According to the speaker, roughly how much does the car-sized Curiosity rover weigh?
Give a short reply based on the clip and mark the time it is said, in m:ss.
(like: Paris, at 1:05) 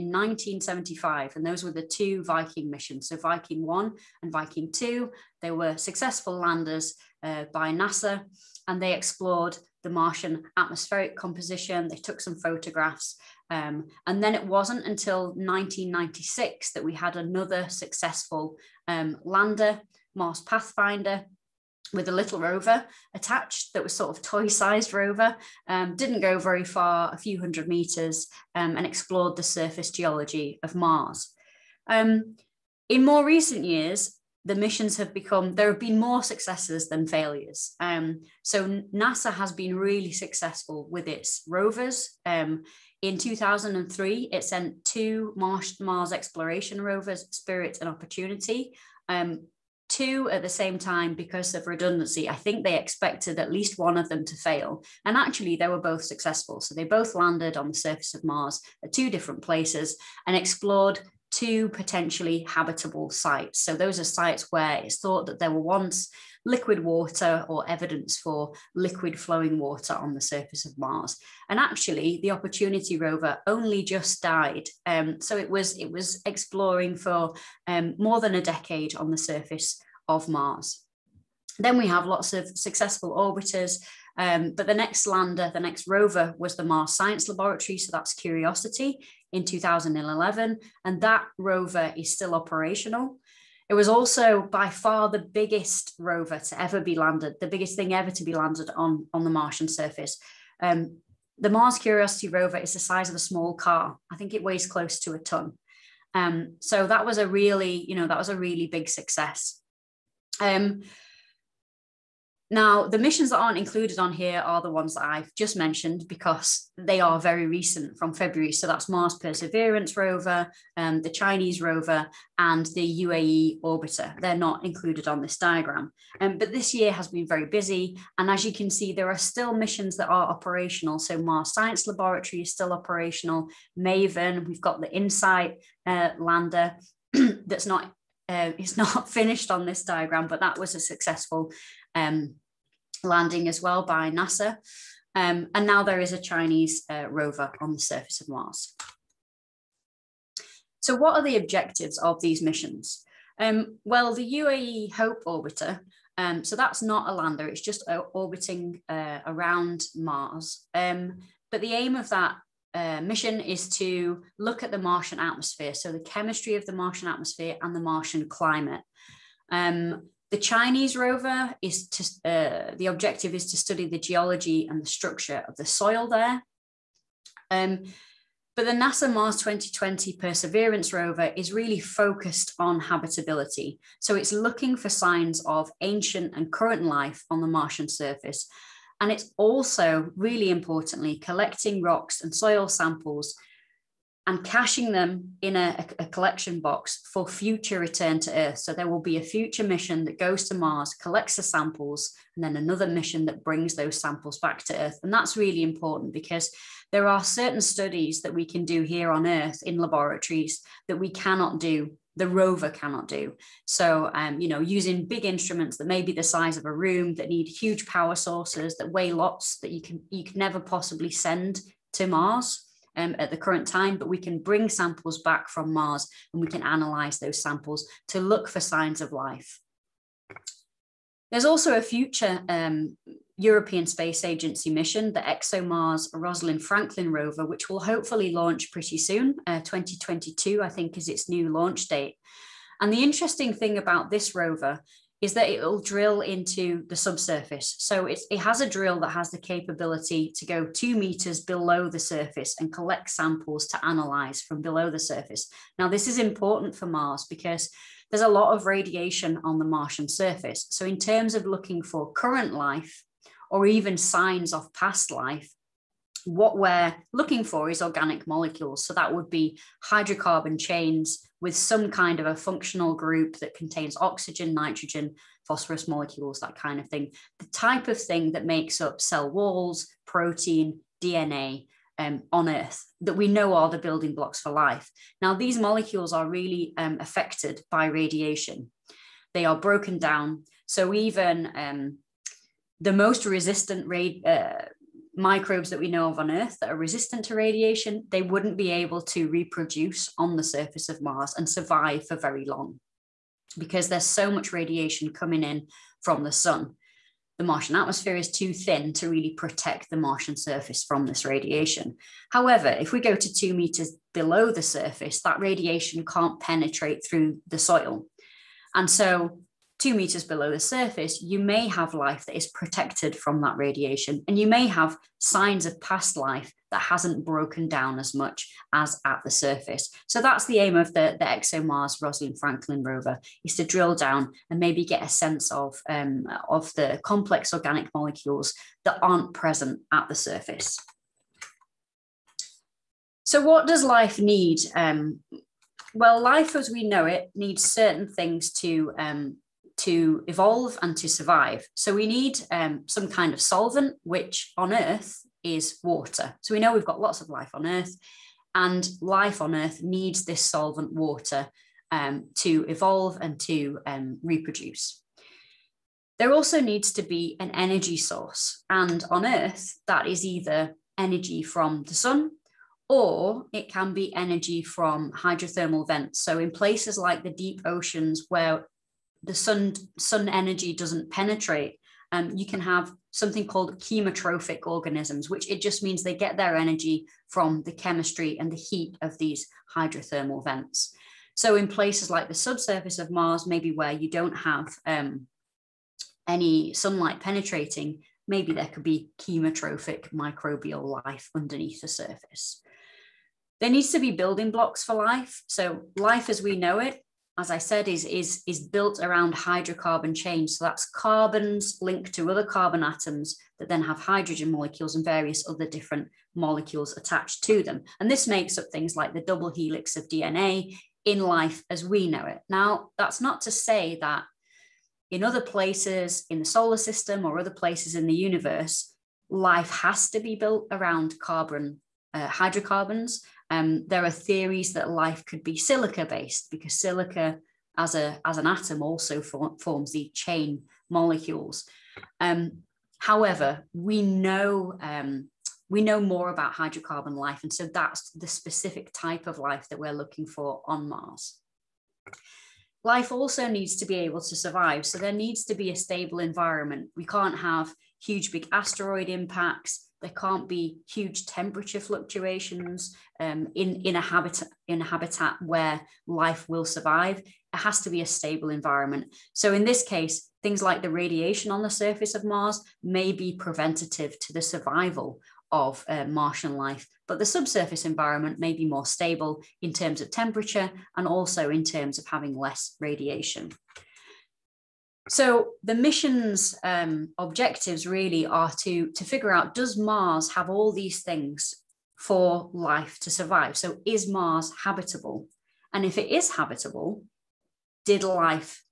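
Close to a ton, at 1:44.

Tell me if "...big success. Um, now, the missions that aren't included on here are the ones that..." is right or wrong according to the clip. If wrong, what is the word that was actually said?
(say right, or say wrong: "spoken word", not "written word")
right.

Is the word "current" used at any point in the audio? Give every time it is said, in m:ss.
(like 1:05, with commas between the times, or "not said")
3:06, 3:43, 4:22.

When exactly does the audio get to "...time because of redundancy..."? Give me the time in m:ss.
0:50.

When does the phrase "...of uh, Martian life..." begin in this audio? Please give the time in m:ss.
7:55.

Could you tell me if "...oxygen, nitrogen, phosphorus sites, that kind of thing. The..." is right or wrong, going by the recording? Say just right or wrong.
wrong.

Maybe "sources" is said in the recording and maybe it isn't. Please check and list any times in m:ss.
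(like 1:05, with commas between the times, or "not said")
3:38, 6:07.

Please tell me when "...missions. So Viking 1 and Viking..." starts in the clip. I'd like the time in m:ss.
0:02.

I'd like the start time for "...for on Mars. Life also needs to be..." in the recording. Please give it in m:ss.
7:30.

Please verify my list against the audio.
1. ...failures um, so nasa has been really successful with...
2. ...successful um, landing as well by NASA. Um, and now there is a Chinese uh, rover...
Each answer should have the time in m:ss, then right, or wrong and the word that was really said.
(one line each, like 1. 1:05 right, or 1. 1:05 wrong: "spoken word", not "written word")
1. 0:37 right
2. 2:20 right.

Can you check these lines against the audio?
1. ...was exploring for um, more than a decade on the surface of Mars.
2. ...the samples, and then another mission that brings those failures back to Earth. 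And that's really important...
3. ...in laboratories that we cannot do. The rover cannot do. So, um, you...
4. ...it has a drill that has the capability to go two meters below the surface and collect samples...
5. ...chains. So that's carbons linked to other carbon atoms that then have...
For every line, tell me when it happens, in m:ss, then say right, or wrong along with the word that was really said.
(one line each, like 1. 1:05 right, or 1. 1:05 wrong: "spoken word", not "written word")
1. 1:15 right
2. 3:21 wrong: "samples", not "failures"
3. 3:29 right
4. 4:08 right
5. 6:50 right.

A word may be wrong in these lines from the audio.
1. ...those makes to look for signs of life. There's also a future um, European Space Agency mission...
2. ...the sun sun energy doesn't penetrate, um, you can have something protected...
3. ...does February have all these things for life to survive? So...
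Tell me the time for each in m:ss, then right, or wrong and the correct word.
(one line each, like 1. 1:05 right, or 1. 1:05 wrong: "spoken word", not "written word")
1. 3:47 wrong: "samples", not "makes"
2. 6:19 wrong: "called", not "protected"
3. 8:09 wrong: "Mars", not "February".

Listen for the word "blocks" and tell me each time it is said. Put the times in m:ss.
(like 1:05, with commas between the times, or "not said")
4:44, 6:44.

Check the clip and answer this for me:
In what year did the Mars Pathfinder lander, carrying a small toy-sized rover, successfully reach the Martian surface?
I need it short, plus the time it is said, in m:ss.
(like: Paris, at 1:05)
1996, at 0:15.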